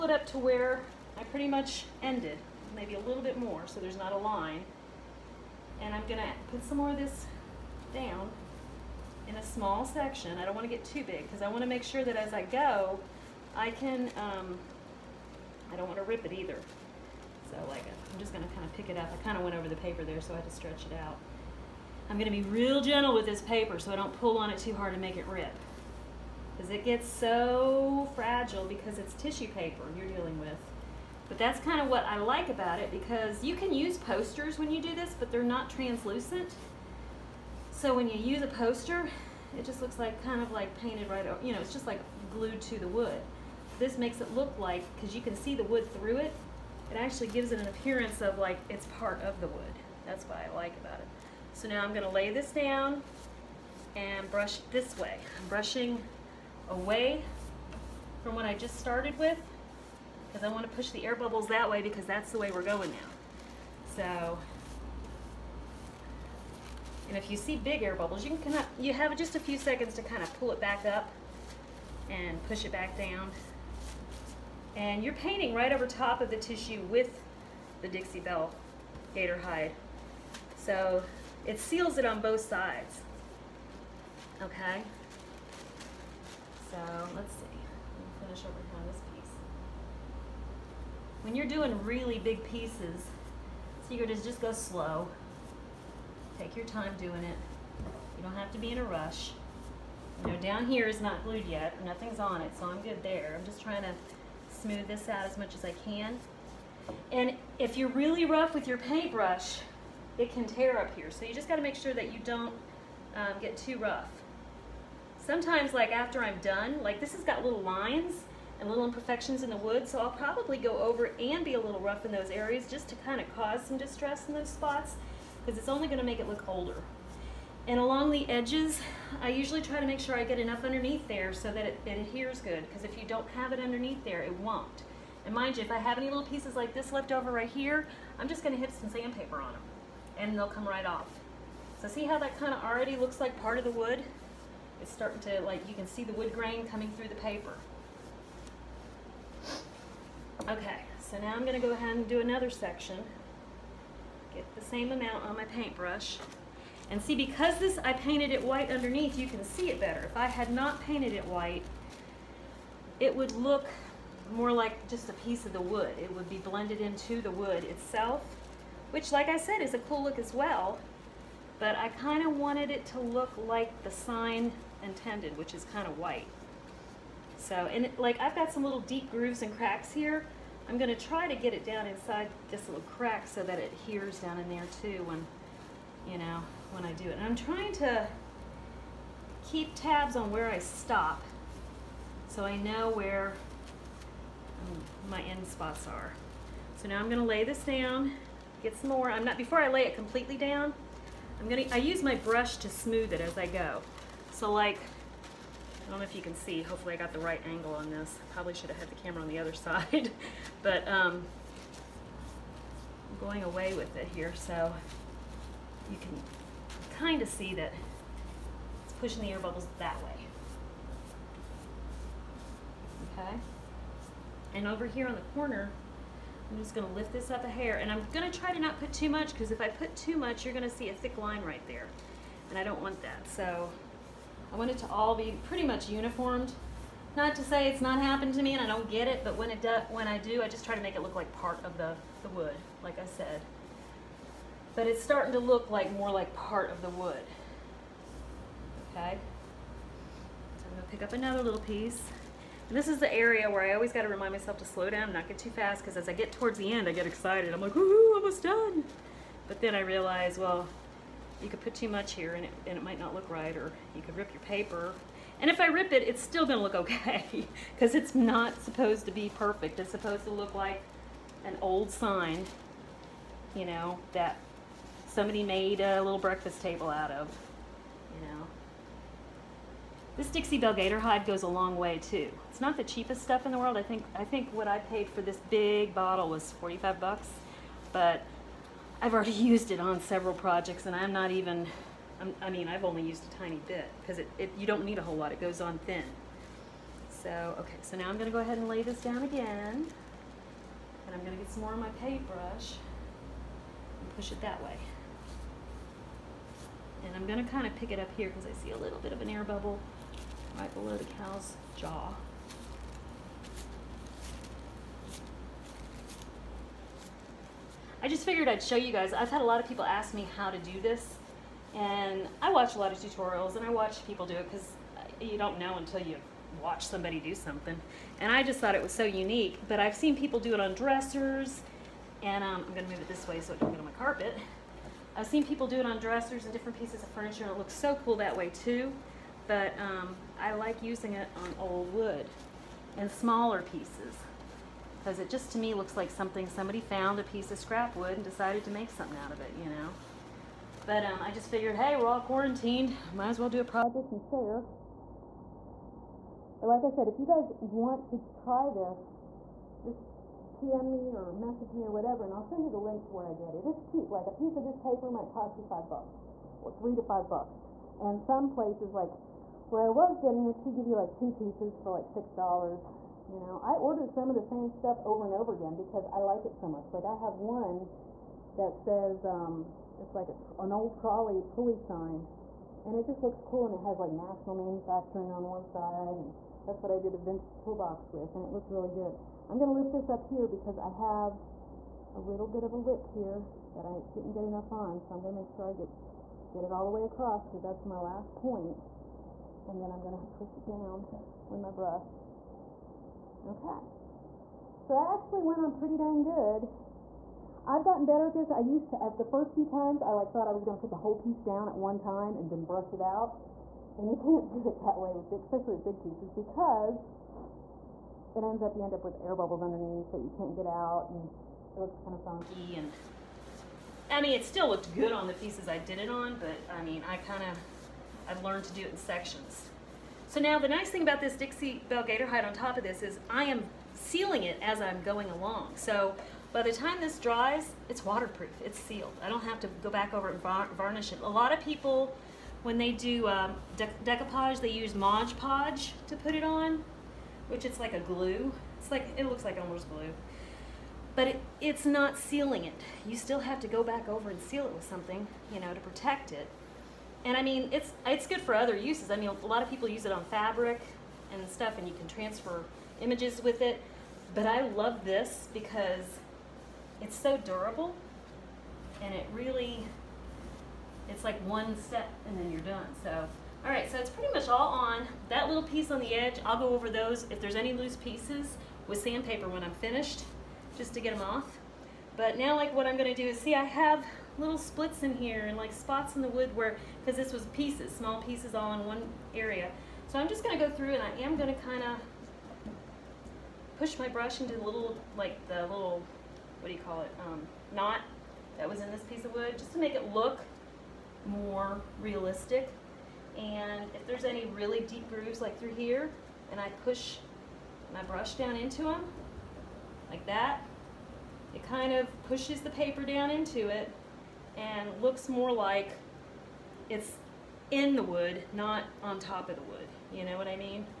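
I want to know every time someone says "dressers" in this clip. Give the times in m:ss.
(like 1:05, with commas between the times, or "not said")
5:30, 5:35.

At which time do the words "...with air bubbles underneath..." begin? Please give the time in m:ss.
6:59.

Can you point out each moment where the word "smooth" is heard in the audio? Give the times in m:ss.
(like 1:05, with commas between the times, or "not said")
1:44, 3:22.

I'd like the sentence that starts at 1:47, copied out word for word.
And if you're really rough with your paintbrush, it can tear up here.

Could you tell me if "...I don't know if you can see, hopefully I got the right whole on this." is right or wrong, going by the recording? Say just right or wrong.
wrong.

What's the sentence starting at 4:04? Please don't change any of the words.
But it's starting to look like more like part of the wood.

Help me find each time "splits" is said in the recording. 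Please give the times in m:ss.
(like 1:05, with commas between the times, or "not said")
8:04.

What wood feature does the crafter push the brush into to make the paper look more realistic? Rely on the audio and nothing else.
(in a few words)
knot.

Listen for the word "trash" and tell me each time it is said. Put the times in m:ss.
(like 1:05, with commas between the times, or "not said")
not said.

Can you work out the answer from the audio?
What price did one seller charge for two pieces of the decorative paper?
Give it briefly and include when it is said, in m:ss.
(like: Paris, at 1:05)
$6, at 6:12.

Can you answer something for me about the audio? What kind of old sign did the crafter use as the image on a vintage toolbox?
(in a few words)
trolley pulley sign.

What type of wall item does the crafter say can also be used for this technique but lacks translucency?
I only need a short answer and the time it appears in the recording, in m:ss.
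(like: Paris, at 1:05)
posters, at 0:33.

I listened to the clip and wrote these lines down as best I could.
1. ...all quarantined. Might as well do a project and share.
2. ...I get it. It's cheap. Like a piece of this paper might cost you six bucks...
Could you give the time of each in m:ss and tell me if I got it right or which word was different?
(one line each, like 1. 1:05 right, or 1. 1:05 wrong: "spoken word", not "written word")
1. 5:52 right
2. 6:03 wrong: "five", not "six".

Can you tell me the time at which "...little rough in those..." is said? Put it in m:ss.
2:01.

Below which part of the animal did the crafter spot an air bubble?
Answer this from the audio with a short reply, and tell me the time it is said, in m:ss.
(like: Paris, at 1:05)
the cow's jaw, at 5:11.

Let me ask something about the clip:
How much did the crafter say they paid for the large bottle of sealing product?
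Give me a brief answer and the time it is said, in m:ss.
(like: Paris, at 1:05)
$45, at 4:46.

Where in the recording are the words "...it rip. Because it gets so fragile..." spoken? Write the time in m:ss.
0:25.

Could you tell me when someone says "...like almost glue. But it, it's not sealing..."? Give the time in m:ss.
7:29.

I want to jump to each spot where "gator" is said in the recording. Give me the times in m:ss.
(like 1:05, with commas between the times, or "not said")
1:19, 4:40, 7:12.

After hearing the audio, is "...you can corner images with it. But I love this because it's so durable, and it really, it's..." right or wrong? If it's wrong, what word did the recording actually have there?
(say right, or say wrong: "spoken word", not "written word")
wrong: "transfer", not "corner".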